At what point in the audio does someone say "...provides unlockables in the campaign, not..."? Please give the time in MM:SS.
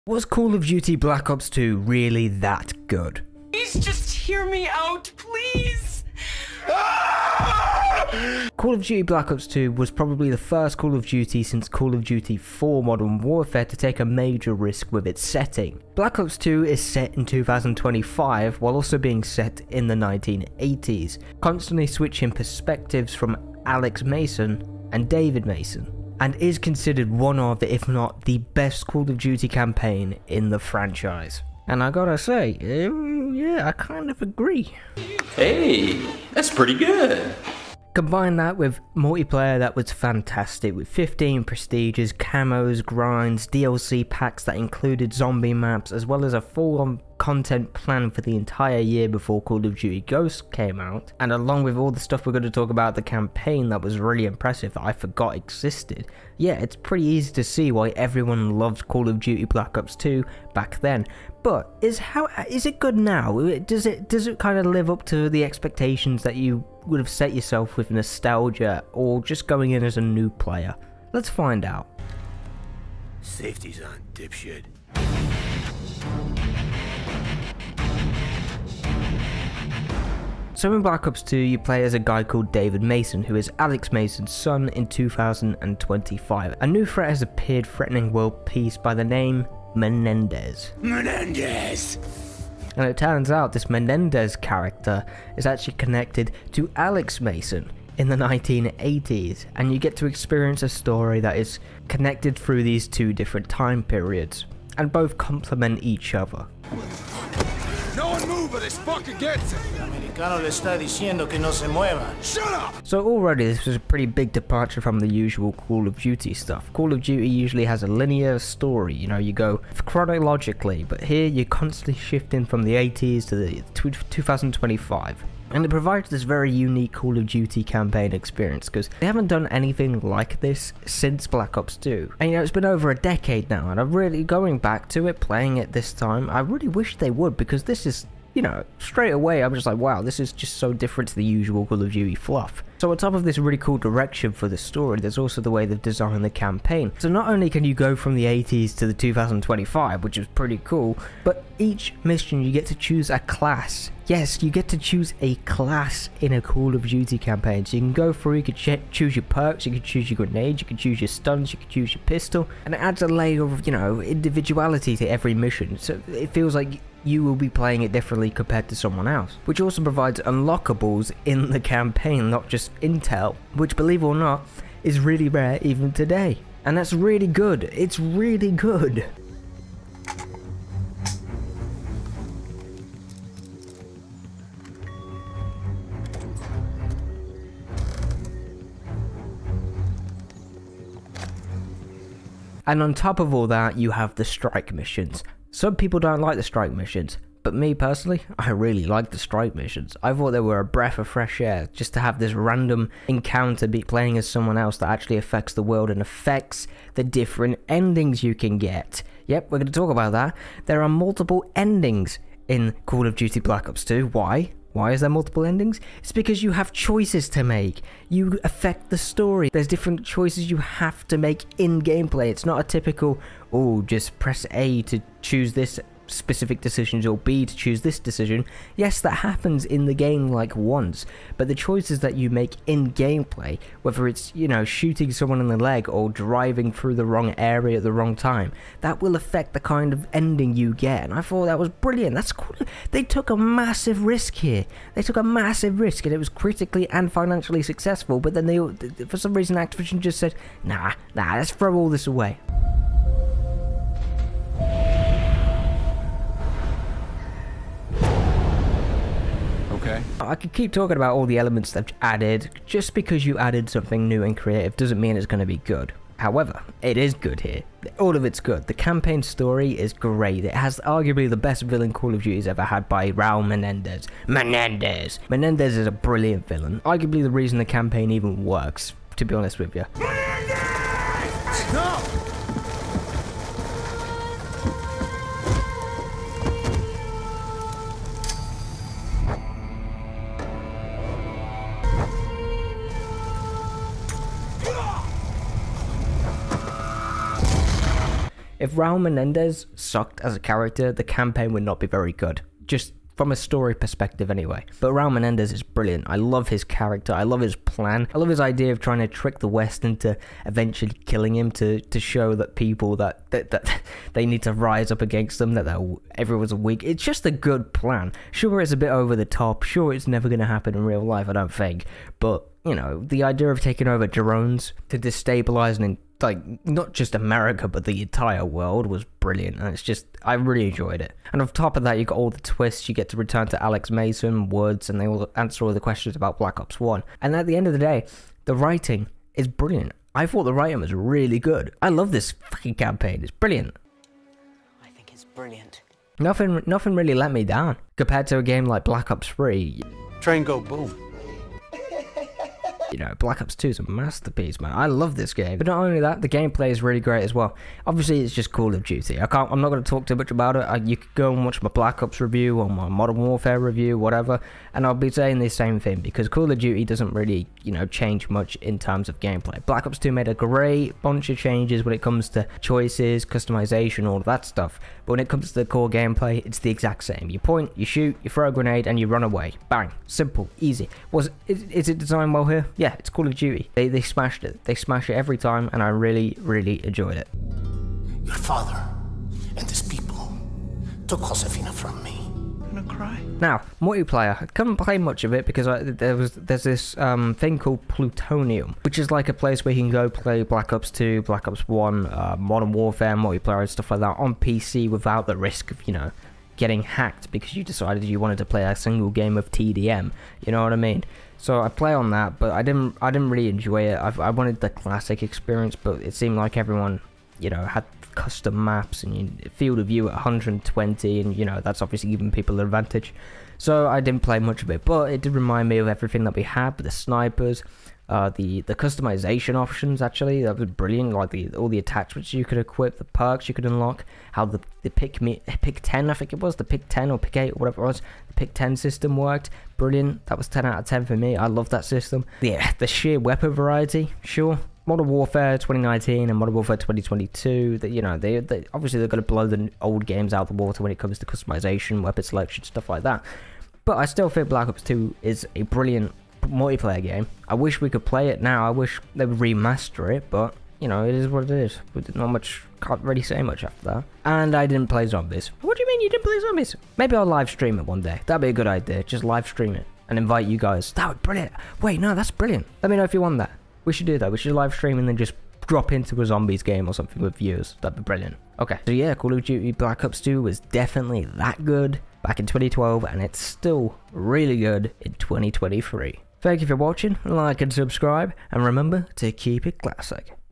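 02:49.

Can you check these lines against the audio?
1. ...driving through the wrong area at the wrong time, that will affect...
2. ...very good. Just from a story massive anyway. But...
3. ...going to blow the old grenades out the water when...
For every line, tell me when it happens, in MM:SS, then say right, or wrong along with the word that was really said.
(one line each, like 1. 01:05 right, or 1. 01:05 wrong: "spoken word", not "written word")
1. 03:56 right
2. 05:01 wrong: "perspective", not "massive"
3. 07:29 wrong: "games", not "grenades".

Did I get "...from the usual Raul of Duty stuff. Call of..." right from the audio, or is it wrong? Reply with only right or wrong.
wrong.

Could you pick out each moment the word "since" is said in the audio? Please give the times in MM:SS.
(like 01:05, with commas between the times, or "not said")
00:11, 02:10.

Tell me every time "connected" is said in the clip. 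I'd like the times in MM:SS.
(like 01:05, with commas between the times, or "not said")
01:35, 01:41.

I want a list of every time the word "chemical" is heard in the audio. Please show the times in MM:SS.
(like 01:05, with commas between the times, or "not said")
not said.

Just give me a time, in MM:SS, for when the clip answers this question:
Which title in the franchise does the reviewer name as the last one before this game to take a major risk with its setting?
00:11.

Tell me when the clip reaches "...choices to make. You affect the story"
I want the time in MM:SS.
03:36.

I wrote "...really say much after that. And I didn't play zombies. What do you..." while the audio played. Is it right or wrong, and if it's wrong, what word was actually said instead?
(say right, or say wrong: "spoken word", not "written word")
right.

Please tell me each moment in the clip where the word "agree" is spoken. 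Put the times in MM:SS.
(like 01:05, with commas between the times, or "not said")
00:34.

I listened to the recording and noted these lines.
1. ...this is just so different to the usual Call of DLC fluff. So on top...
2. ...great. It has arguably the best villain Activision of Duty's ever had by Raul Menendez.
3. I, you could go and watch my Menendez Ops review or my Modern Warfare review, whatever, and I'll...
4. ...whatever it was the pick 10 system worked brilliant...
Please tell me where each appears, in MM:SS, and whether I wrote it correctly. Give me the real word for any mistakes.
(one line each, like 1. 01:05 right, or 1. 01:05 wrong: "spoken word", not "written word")
1. 02:20 wrong: "Duty", not "DLC"
2. 04:29 wrong: "Call", not "Activision"
3. 06:00 wrong: "Black", not "Menendez"
4. 07:17 right.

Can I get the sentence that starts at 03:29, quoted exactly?
Yep, we're going to talk about that.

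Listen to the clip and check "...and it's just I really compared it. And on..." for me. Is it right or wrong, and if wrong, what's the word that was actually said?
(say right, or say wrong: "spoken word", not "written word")
wrong: "enjoyed", not "compared".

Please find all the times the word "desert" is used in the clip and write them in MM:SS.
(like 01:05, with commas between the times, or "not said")
not said.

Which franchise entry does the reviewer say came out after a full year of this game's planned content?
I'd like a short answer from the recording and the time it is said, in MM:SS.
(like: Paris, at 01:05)
Call of Duty Ghosts, at 00:49.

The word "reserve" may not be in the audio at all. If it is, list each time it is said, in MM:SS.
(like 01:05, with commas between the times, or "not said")
not said.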